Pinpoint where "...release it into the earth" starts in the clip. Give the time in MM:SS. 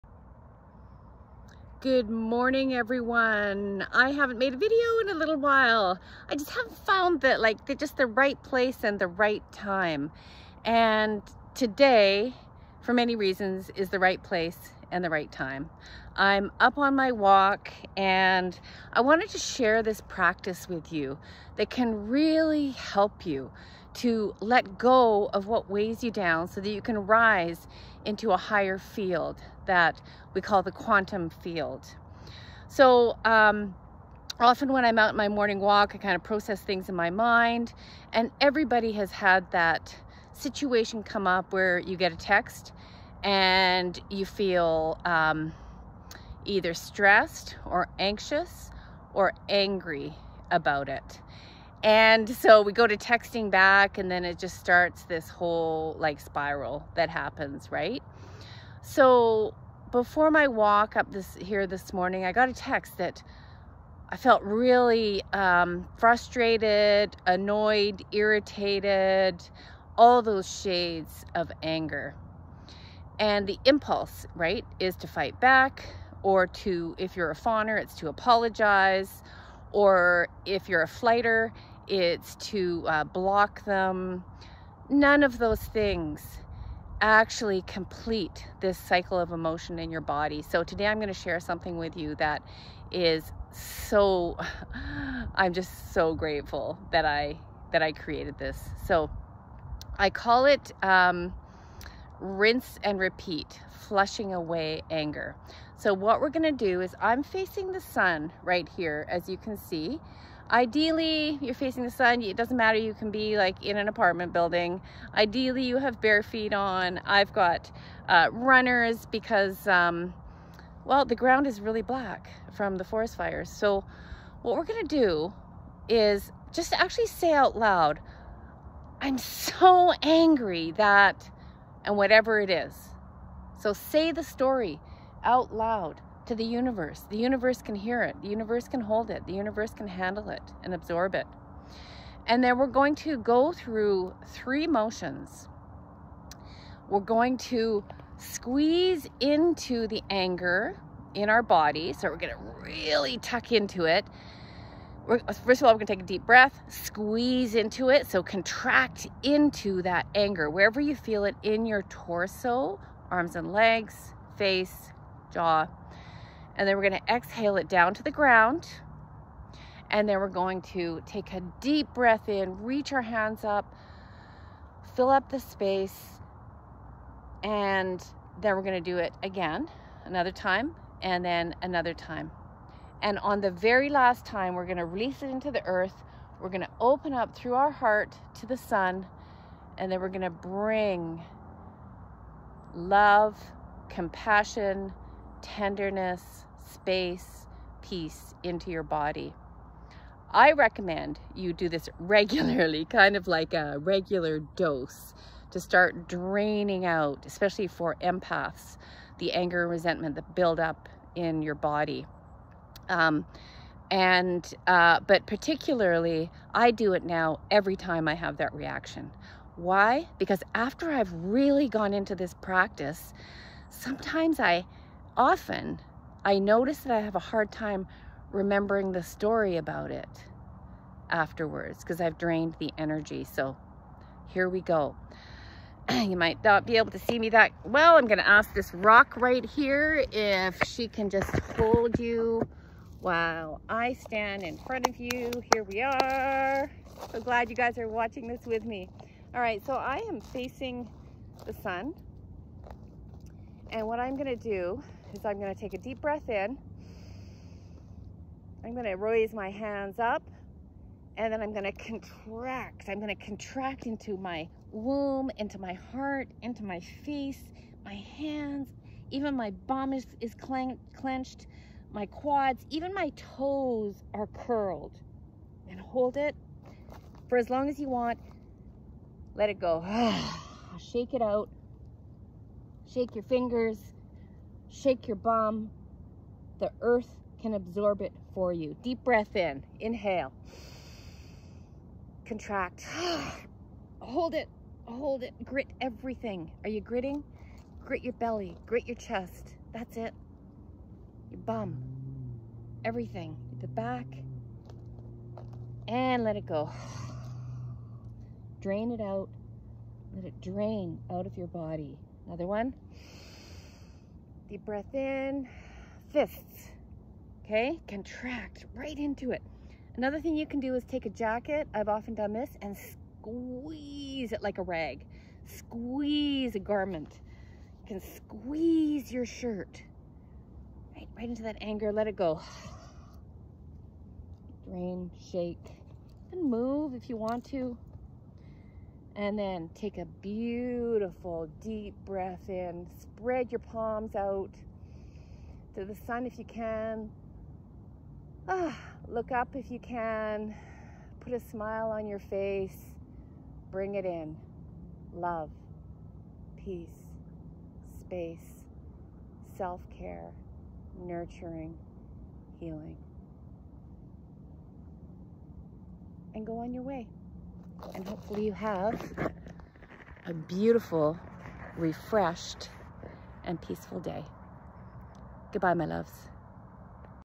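03:04.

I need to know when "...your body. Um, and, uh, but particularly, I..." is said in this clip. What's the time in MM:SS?
03:31.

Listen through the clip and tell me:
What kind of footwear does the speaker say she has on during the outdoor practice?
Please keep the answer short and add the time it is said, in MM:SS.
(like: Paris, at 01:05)
Runners, at 01:58.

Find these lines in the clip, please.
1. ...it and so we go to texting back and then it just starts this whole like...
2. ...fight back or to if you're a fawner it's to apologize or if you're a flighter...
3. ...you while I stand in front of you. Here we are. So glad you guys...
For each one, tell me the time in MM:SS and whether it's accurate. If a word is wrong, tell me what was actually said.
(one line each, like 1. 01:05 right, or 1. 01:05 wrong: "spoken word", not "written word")
1. 00:50 right
2. 01:15 right
3. 04:01 right.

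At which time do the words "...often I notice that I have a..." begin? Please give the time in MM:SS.
03:45.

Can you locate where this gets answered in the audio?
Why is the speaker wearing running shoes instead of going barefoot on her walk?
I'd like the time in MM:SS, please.
02:02.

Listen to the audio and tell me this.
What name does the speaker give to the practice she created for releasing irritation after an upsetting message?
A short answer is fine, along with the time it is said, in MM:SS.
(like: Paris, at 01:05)
Rinse and repeat, at 01:42.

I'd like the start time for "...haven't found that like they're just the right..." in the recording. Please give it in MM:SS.
00:06.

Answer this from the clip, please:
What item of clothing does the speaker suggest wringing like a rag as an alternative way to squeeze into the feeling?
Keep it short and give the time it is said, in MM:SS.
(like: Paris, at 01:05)
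A jacket, at 05:21.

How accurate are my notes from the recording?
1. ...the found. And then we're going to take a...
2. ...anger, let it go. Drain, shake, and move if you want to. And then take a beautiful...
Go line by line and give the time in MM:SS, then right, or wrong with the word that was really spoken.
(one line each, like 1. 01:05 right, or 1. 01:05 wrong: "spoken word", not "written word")
1. 02:48 wrong: "ground", not "found"
2. 05:31 right.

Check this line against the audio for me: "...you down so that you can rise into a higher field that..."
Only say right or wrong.
right.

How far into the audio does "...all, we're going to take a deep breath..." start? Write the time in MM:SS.
02:35.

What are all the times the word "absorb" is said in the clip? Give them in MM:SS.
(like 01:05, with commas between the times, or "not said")
02:20, 04:47.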